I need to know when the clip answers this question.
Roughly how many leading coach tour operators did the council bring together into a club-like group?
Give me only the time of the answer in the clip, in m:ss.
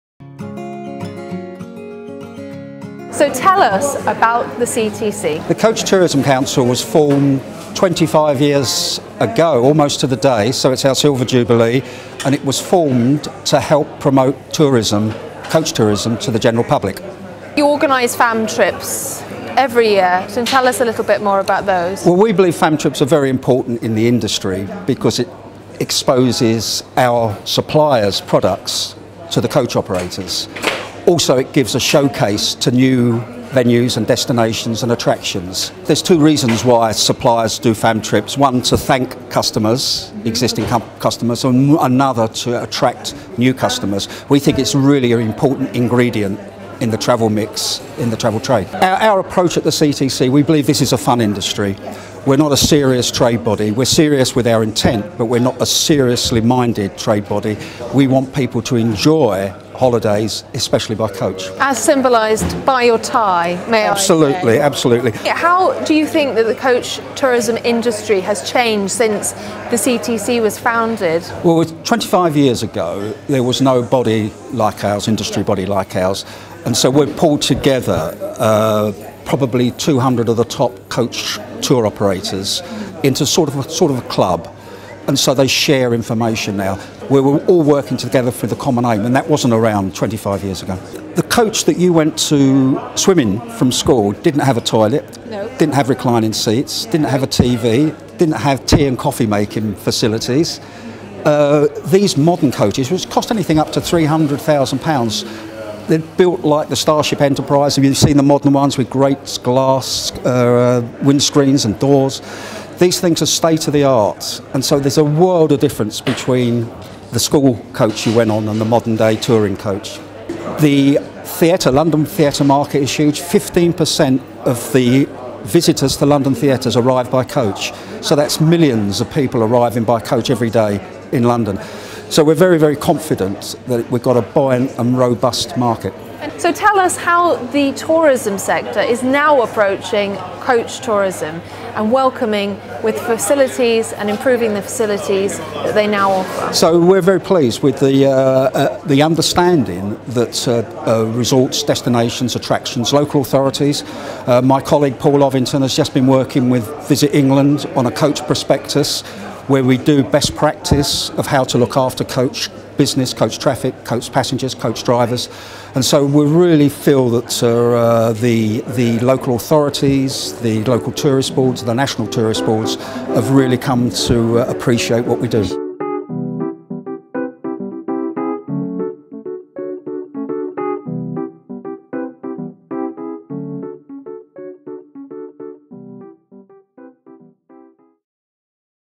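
1:19.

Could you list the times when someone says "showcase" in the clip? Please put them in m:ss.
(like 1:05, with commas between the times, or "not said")
0:31.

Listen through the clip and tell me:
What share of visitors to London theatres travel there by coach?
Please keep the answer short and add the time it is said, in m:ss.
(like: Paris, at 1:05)
15%, at 2:03.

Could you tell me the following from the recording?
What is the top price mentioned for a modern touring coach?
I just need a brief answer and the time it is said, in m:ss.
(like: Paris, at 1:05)
£300,000, at 1:43.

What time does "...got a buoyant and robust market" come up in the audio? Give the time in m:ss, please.
2:14.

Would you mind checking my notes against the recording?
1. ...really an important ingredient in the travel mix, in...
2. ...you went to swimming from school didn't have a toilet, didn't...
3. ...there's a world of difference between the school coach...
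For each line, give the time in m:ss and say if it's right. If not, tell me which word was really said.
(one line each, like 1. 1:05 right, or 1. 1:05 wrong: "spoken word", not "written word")
1. 0:44 right
2. 1:31 right
3. 1:54 right.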